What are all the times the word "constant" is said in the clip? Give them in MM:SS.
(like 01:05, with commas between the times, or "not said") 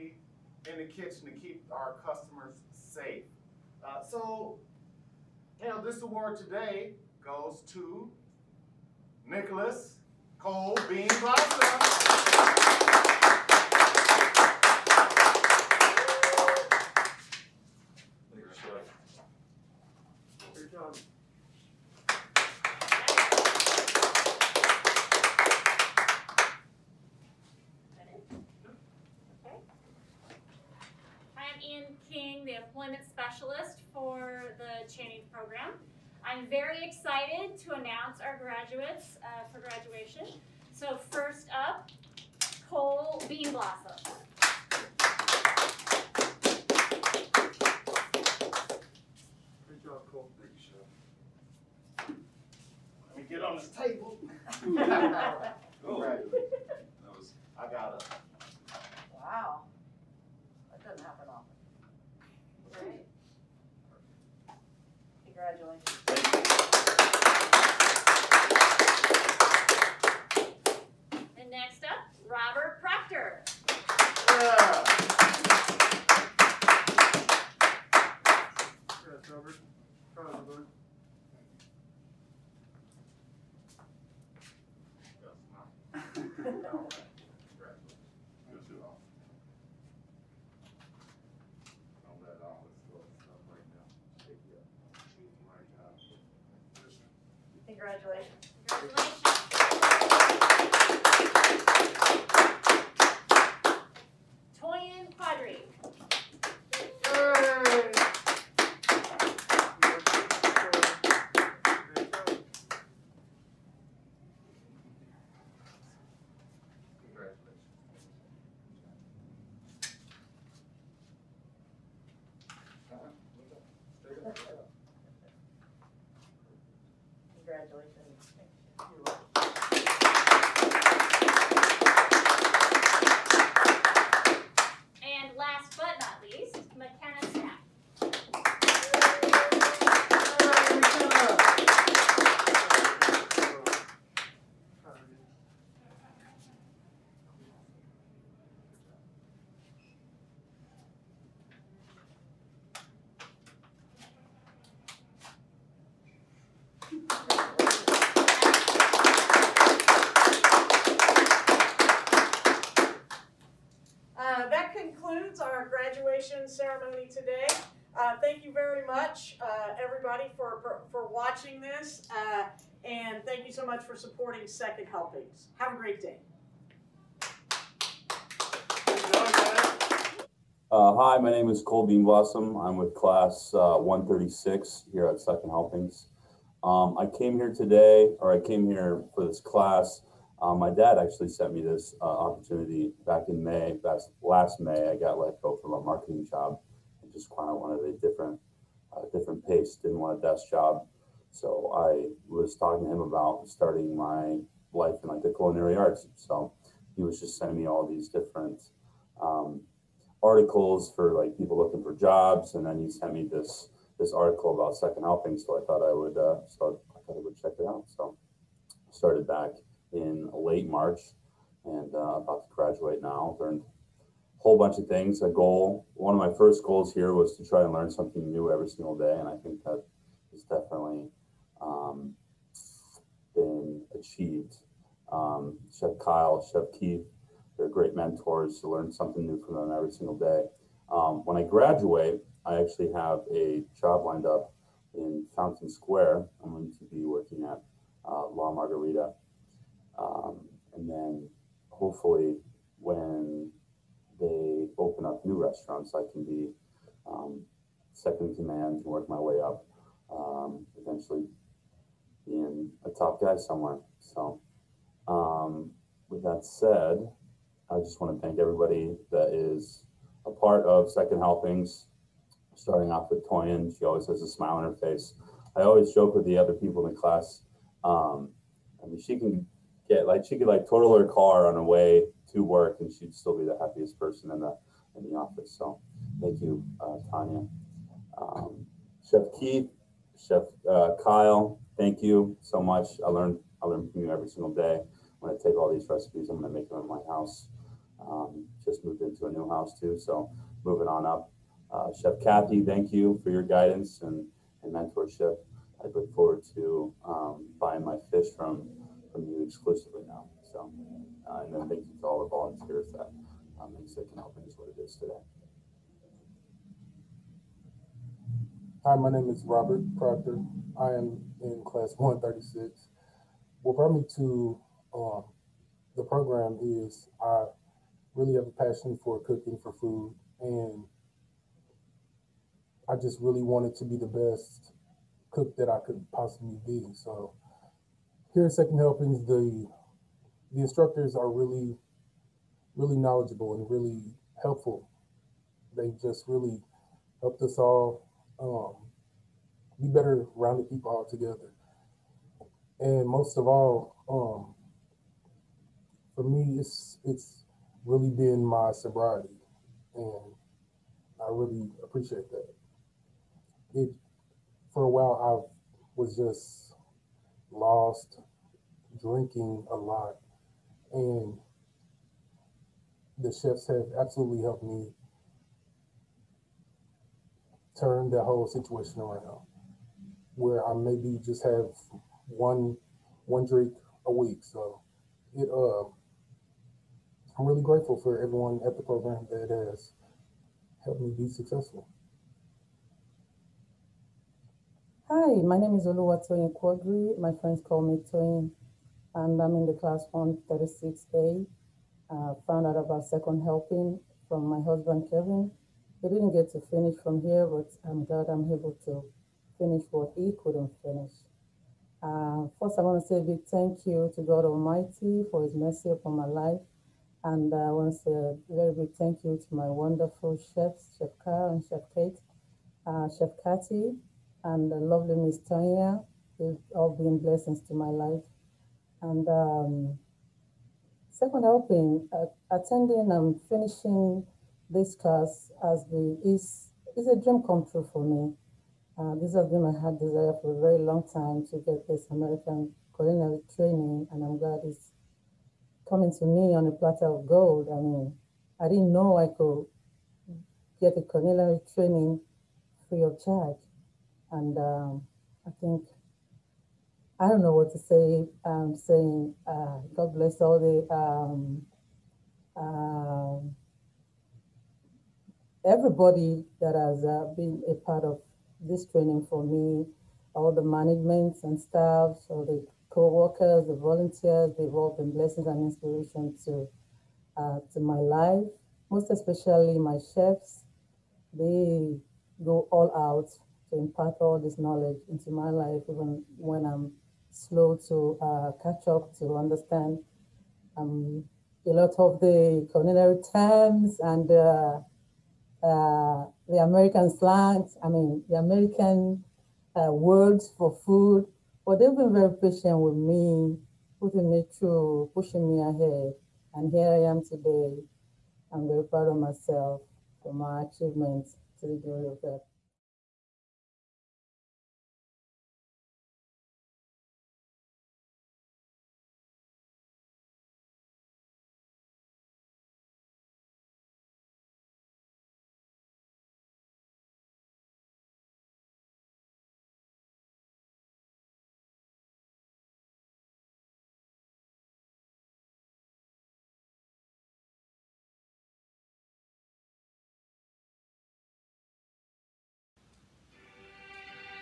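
not said.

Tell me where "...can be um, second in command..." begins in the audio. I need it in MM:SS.
04:16.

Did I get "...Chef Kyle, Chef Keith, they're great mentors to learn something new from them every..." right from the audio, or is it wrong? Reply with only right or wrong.
right.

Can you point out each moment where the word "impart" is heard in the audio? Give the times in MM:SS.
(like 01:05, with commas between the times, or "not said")
08:03.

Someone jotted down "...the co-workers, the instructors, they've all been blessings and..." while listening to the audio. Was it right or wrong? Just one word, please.
wrong.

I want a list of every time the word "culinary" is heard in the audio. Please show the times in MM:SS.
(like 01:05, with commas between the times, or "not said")
03:25, 07:22, 07:31, 08:12.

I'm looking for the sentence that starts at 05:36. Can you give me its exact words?
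So here at Second Helpings, the the instructors are really, really knowledgeable and really helpful.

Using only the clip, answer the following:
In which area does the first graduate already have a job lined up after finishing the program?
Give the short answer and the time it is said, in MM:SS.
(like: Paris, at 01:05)
Fountain Square, at 04:05.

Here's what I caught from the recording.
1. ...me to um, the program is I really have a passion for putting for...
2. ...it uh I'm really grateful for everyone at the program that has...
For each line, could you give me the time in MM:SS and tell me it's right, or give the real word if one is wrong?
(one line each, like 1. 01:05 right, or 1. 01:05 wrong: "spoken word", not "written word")
1. 05:23 wrong: "cooking", not "putting"
2. 06:25 right.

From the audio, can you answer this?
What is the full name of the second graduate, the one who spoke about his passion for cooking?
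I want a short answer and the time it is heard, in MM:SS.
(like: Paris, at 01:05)
Robert Proctor, at 05:19.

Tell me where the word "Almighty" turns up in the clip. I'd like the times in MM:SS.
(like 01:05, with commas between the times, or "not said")
06:54.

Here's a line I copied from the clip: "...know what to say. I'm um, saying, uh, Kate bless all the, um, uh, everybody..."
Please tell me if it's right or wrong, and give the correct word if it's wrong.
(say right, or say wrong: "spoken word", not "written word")
wrong: "God", not "Kate".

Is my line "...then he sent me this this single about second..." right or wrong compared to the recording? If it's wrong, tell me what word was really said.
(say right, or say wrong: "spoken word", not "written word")
wrong: "article", not "single".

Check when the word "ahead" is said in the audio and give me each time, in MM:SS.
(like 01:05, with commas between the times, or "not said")
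08:25.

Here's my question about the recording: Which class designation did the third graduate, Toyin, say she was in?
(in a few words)
136A.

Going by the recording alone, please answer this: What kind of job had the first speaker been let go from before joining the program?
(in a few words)
Marketing job.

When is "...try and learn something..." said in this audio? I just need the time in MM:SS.
03:47.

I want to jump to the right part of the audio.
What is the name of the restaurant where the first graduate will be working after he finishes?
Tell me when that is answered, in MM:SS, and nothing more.
04:08.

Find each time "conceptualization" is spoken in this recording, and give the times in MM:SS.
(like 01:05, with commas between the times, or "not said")
not said.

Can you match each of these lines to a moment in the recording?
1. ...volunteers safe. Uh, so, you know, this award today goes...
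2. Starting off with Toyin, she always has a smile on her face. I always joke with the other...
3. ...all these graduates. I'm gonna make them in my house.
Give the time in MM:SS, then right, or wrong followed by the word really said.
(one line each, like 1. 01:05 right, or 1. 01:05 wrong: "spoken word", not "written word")
1. 00:02 wrong: "customers", not "volunteers"
2. 04:32 right
3. 04:55 wrong: "recipes", not "graduates".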